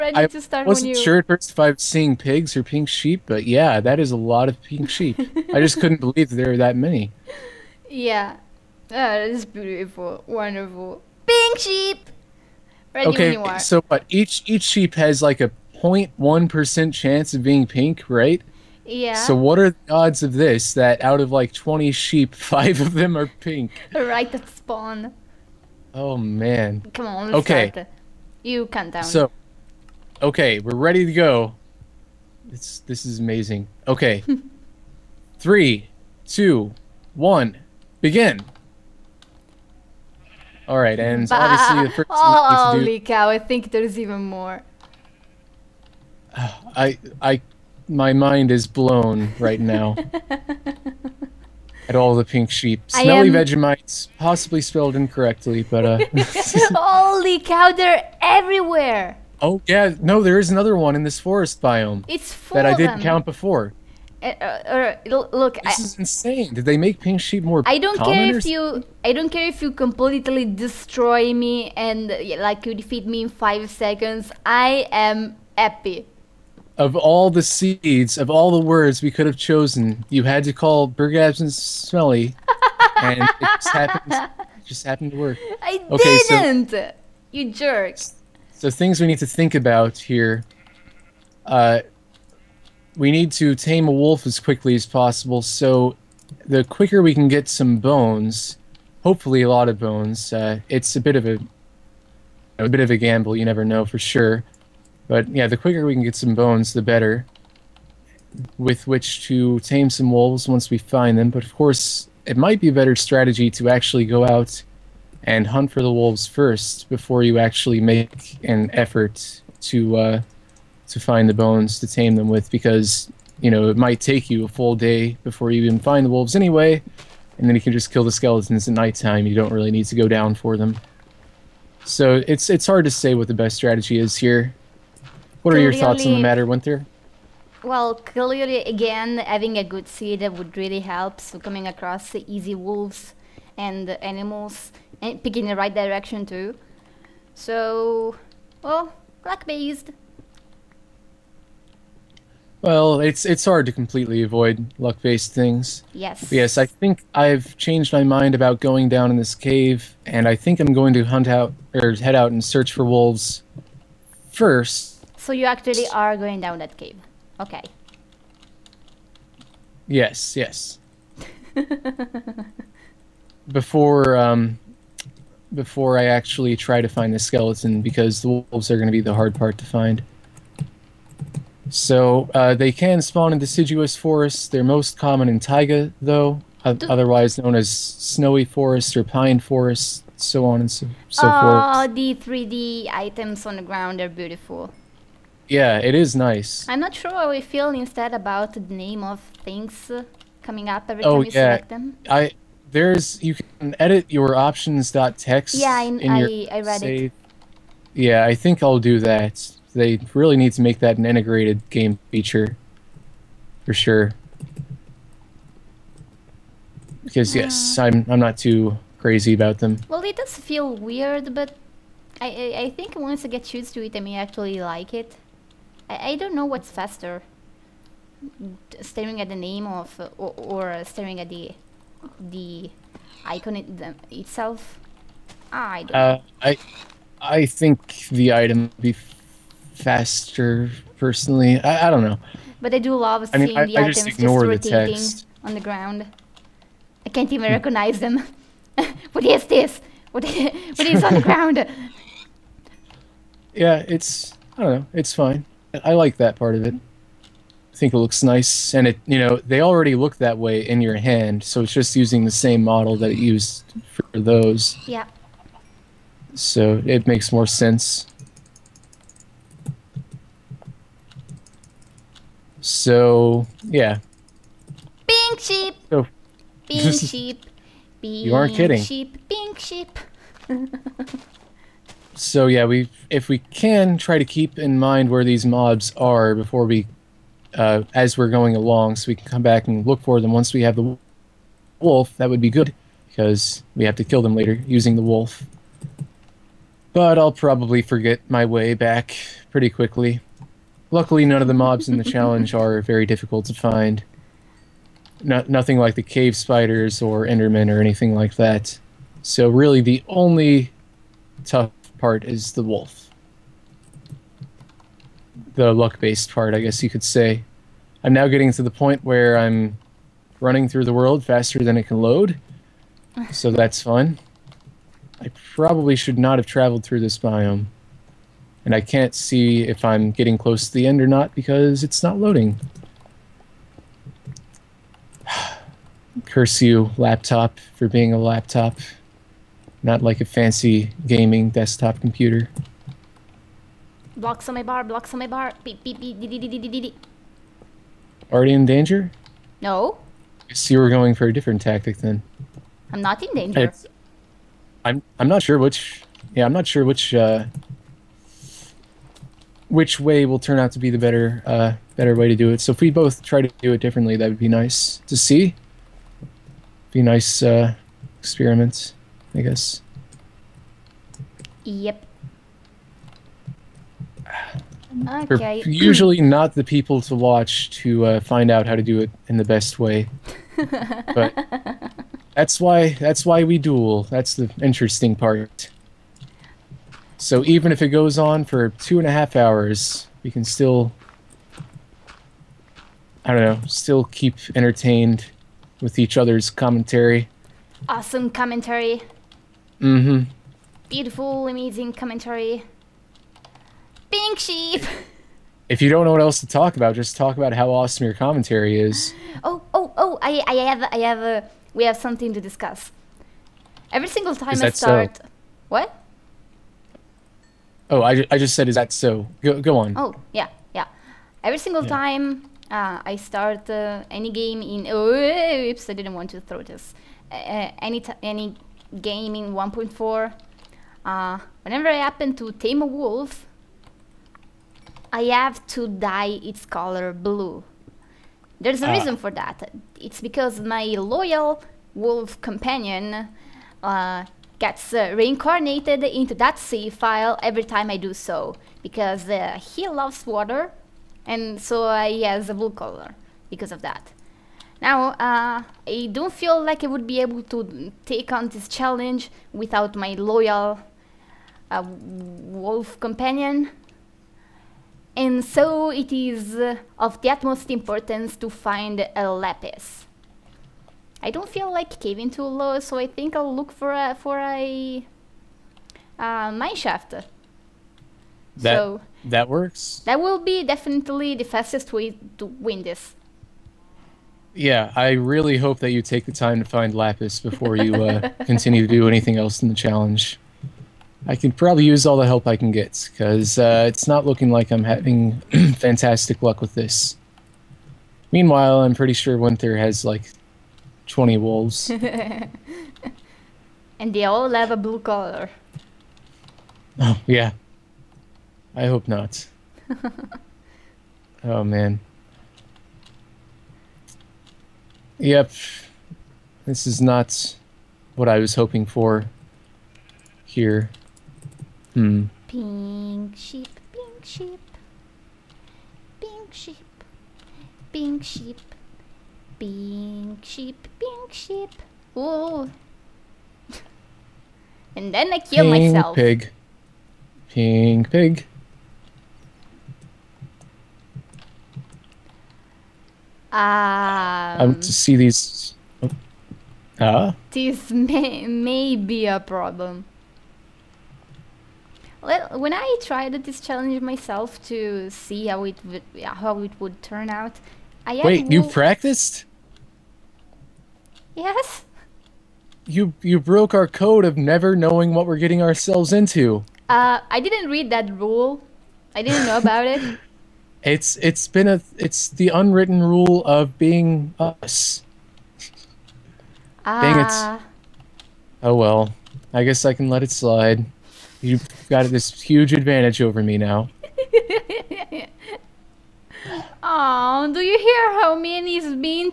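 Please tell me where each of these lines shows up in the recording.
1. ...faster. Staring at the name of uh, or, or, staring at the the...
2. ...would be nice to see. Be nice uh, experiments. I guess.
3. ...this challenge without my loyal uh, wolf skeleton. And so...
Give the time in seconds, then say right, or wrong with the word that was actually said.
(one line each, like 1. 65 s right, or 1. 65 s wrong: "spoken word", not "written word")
1. 226 s right
2. 364 s right
3. 458 s wrong: "companion", not "skeleton".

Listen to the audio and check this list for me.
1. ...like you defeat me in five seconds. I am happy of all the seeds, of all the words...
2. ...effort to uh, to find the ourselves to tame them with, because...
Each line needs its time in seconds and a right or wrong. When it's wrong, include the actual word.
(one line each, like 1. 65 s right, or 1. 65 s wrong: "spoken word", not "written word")
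1. 72 s right
2. 118 s wrong: "bones", not "ourselves".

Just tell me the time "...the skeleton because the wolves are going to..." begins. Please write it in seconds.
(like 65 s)
177 s.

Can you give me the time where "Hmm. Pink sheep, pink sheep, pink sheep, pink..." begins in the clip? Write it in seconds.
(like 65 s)
521 s.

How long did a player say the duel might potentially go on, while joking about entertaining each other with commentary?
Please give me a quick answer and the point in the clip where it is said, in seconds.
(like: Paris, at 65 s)
two and a half hours, at 388 s.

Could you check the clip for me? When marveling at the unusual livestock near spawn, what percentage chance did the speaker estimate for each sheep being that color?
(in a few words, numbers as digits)
0.1 percent.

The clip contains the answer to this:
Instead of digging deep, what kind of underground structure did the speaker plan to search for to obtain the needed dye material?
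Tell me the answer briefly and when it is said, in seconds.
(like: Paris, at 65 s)
mine shaft, at 476 s.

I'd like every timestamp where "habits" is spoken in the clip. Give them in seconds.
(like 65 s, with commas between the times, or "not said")
not said.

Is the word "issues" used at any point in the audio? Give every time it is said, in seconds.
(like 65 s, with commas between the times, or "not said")
not said.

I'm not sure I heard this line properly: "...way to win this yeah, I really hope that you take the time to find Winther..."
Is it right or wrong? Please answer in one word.
wrong.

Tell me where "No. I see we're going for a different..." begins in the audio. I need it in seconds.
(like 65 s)
349 s.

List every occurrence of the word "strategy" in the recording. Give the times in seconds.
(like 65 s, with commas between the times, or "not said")
112 s, 133 s.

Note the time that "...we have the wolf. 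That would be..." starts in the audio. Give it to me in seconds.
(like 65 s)
290 s.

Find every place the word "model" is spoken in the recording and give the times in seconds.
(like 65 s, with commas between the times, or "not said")
262 s.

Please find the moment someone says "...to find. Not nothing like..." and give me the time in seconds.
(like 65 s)
303 s.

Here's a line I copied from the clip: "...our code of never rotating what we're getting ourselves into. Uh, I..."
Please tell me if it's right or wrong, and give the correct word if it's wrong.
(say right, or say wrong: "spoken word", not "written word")
wrong: "knowing", not "rotating".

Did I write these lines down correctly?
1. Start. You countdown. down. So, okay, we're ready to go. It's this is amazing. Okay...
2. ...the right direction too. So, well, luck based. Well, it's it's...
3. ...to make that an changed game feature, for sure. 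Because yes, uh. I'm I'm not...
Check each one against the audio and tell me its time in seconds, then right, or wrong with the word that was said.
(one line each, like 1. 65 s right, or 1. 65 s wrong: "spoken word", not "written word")
1. 27 s right
2. 145 s right
3. 210 s wrong: "integrated", not "changed".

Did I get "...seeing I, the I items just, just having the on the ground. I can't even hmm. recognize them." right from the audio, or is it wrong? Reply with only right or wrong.
wrong.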